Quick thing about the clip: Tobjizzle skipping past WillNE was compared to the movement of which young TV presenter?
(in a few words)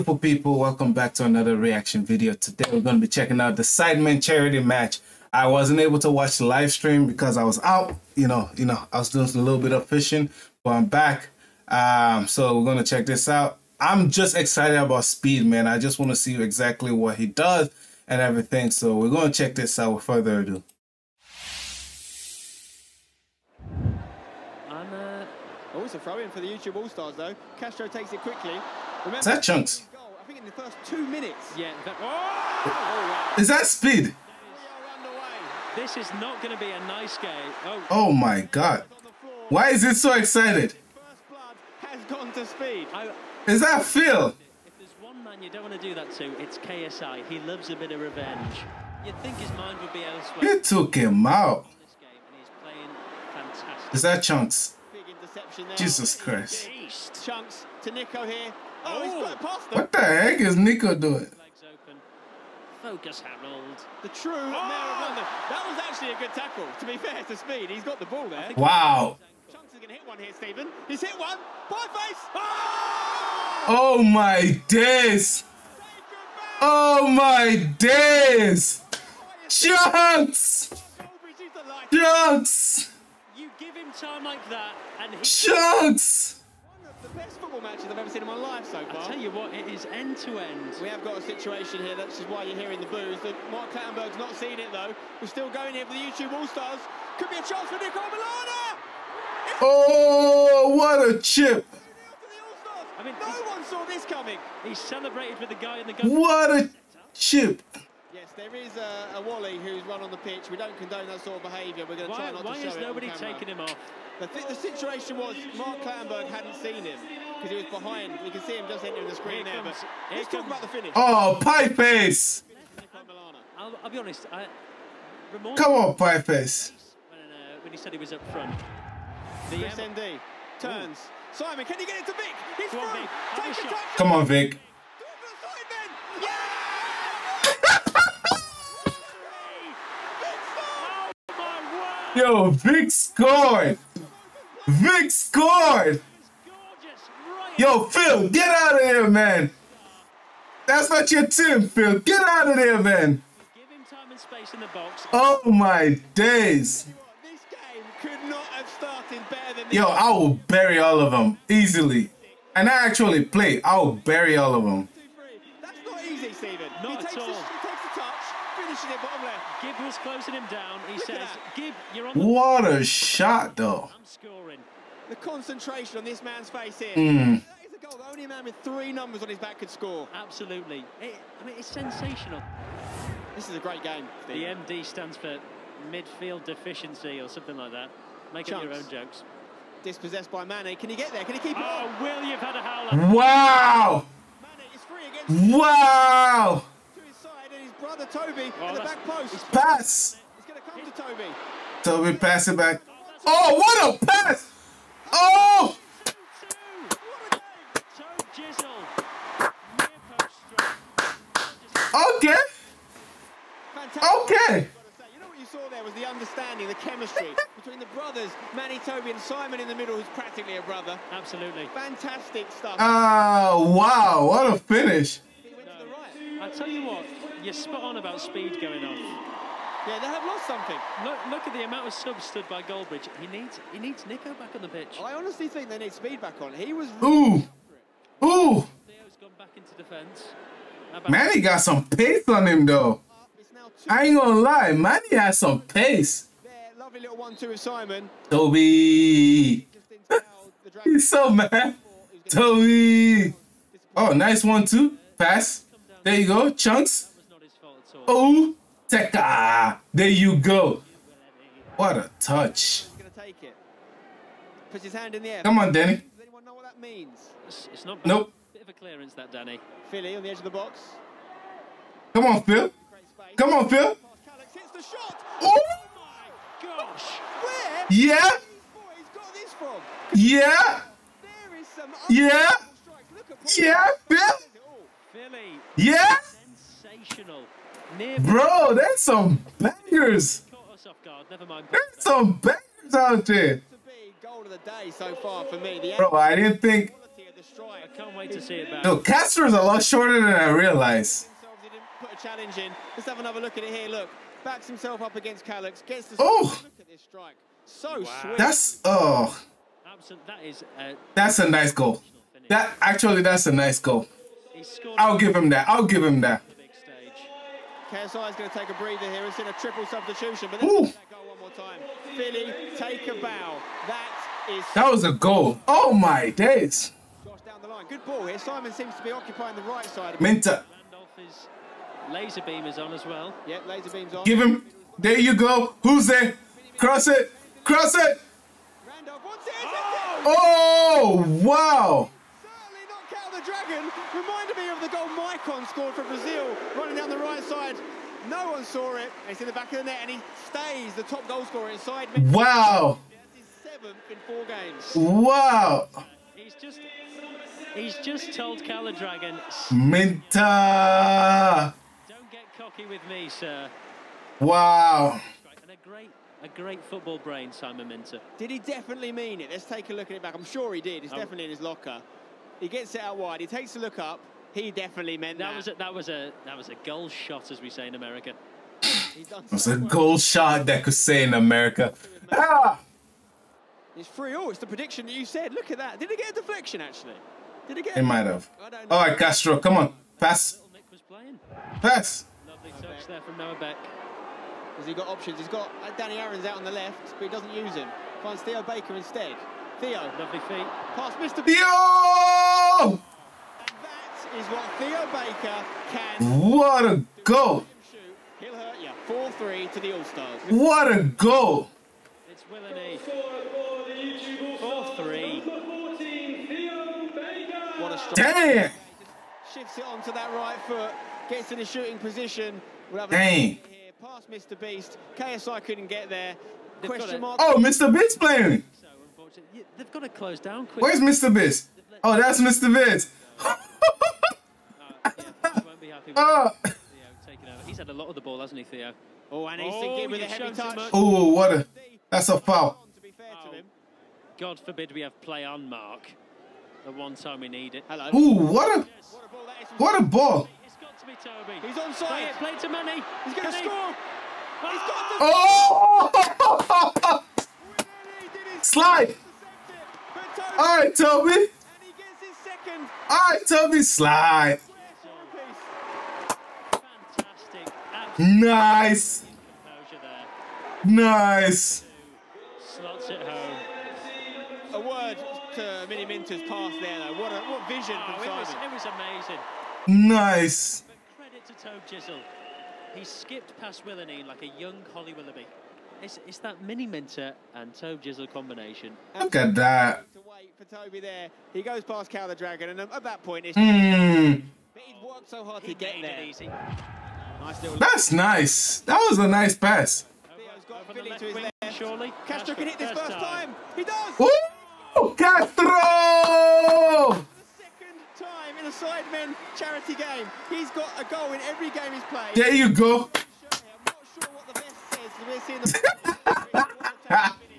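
Holly Willoughby.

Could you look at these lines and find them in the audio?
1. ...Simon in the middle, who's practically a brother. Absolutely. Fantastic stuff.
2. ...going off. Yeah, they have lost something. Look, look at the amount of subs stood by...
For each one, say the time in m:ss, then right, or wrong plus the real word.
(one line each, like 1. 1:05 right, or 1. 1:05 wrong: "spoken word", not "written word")
1. 3:39 right
2. 3:48 right.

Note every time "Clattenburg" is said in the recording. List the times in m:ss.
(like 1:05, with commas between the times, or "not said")
1:33, 1:55.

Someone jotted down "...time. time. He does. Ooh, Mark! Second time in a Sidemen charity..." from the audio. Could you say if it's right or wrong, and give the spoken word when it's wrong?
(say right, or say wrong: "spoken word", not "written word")
wrong: "Castro", not "Mark".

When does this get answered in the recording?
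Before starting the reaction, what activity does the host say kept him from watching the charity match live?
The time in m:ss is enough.
0:09.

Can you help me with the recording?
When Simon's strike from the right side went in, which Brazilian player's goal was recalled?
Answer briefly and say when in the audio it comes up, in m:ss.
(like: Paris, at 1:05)
Maicon, at 5:45.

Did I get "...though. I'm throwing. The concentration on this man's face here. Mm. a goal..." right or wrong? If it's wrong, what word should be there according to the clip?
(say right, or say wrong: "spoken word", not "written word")
wrong: "scoring", not "throwing".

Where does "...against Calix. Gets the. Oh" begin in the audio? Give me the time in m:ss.
5:05.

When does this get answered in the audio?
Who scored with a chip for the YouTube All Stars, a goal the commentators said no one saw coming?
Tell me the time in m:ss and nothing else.
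1:37.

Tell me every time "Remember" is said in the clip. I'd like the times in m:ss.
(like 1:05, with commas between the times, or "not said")
0:29.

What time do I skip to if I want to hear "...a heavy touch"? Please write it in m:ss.
7:20.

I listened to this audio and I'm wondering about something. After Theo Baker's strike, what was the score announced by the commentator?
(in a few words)
4-3.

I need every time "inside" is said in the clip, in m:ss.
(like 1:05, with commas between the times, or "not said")
5:51.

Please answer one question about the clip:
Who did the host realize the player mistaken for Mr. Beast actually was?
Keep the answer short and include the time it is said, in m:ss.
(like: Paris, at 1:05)
Mr. Vince, at 7:12.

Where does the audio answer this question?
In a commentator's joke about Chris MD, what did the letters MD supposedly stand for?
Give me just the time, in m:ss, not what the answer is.
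3:05.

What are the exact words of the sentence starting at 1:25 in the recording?
Chunkz football matches I've ever seen in my life so far.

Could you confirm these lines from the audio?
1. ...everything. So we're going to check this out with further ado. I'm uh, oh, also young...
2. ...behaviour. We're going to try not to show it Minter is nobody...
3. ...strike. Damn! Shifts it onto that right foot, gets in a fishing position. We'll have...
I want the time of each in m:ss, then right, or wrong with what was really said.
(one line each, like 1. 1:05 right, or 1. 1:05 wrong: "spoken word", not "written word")
1. 0:18 wrong: "throwing", not "young"
2. 1:51 wrong: "Why", not "Minter"
3. 6:57 wrong: "shooting", not "fishing".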